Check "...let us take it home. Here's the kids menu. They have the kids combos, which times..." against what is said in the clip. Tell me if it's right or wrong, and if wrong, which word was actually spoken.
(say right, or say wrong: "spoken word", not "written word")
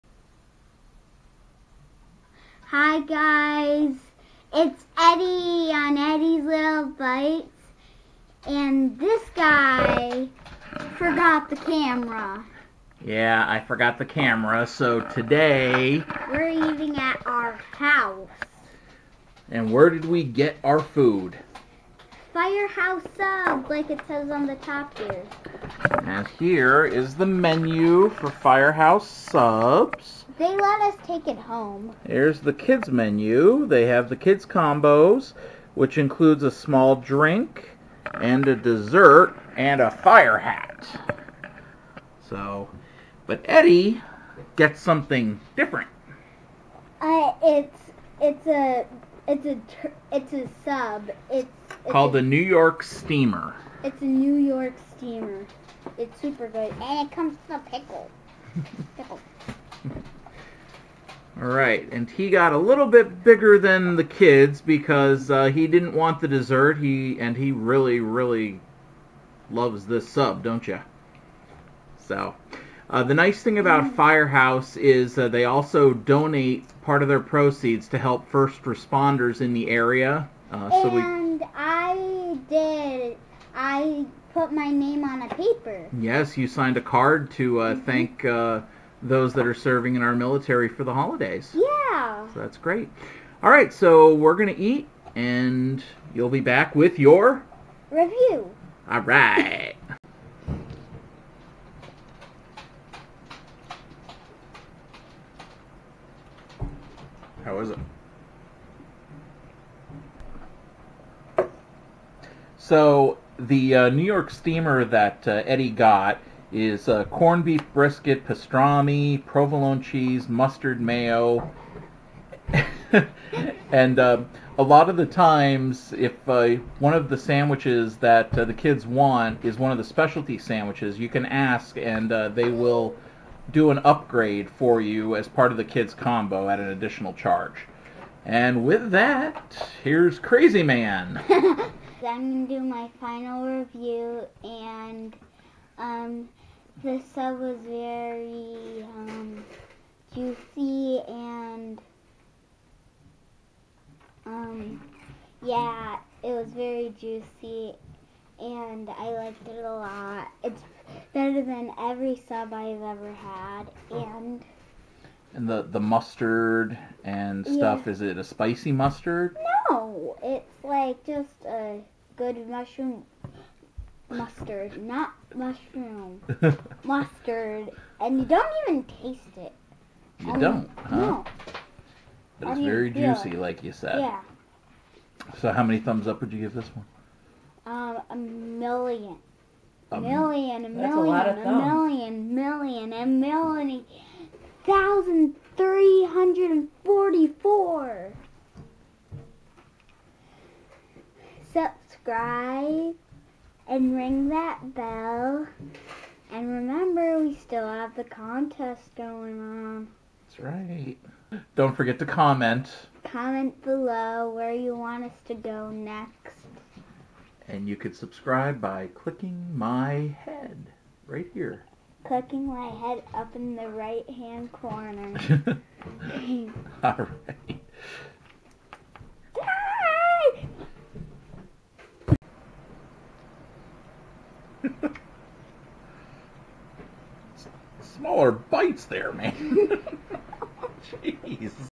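wrong: "includes", not "times".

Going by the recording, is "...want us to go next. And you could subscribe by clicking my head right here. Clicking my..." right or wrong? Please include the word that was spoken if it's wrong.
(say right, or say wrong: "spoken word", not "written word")
right.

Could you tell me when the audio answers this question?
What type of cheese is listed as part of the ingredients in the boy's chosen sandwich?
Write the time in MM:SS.
01:59.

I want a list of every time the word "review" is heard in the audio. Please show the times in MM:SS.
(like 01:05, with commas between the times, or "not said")
01:37, 02:23.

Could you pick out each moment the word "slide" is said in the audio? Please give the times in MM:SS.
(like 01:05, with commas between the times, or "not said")
not said.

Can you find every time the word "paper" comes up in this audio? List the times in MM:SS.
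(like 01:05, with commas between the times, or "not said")
01:25.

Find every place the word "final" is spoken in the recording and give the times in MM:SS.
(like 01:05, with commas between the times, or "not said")
02:22.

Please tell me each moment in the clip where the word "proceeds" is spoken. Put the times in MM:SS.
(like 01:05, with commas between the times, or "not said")
01:17.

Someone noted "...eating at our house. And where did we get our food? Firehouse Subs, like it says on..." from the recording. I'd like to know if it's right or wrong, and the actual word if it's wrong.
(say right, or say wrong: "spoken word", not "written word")
right.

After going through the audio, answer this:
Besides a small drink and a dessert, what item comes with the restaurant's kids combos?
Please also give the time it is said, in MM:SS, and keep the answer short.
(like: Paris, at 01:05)
A fire hat, at 00:39.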